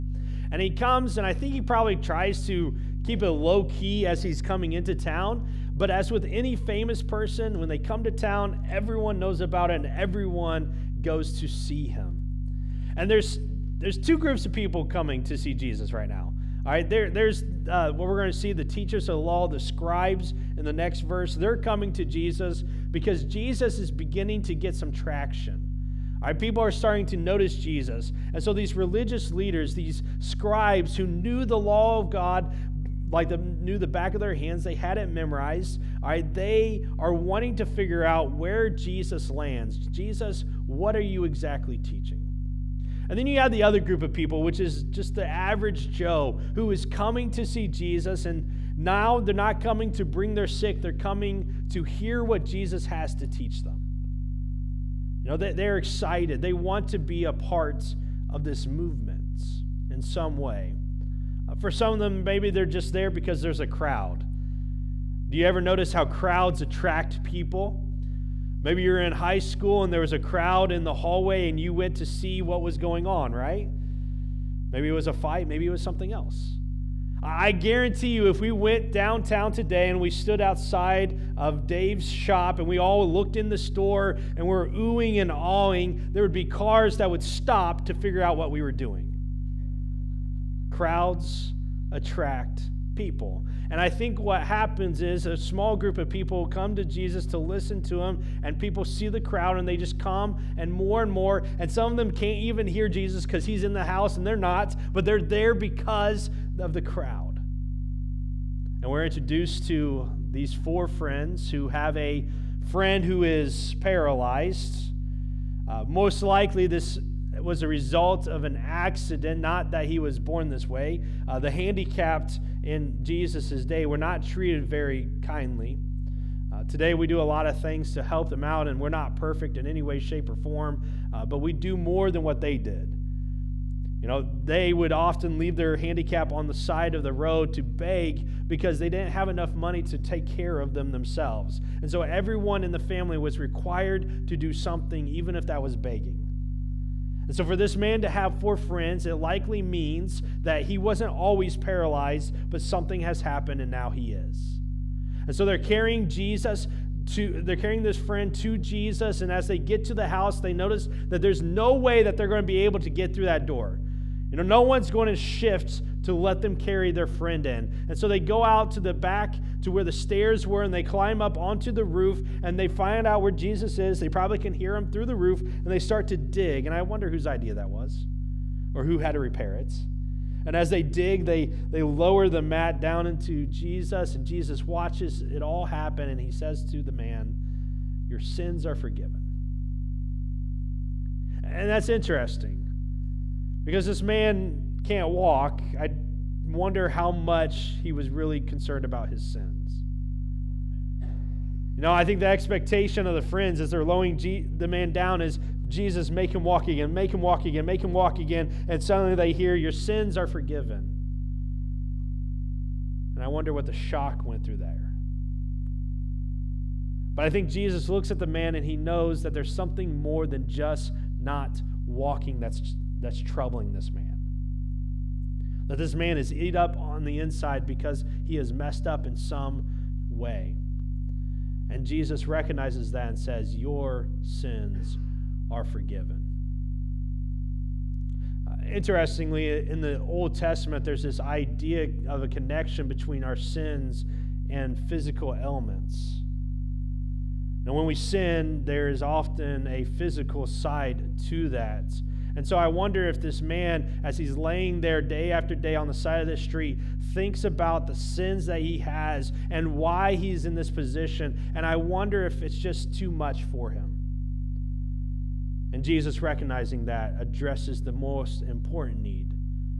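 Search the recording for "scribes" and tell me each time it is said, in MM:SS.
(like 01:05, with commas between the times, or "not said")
00:19, 00:30.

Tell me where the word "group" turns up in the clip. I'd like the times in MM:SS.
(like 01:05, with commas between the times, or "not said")
00:14, 00:43, 01:35.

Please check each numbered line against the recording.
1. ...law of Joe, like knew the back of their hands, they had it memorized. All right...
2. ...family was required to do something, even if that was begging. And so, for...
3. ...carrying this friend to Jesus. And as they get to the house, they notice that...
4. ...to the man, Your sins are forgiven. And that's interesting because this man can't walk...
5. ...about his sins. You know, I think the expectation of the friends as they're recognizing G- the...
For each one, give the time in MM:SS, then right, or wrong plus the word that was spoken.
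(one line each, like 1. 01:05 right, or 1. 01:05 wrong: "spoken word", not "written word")
1. 00:31 wrong: "God", not "Joe"
2. 02:22 right
3. 02:37 right
4. 03:06 right
5. 03:18 wrong: "lowering", not "recognizing".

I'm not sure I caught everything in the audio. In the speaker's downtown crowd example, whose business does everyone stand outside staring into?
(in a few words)
Dave's shop.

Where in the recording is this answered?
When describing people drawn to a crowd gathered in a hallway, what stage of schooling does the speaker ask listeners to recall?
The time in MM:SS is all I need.
01:09.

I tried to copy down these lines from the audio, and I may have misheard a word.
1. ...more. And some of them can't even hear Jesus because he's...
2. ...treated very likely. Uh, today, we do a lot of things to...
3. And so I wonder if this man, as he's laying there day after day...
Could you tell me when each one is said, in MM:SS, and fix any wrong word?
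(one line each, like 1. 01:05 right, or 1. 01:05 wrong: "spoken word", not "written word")
1. 01:41 right
2. 02:04 wrong: "kindly", not "likely"
3. 04:12 right.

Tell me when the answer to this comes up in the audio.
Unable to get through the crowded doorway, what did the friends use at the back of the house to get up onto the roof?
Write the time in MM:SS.
02:49.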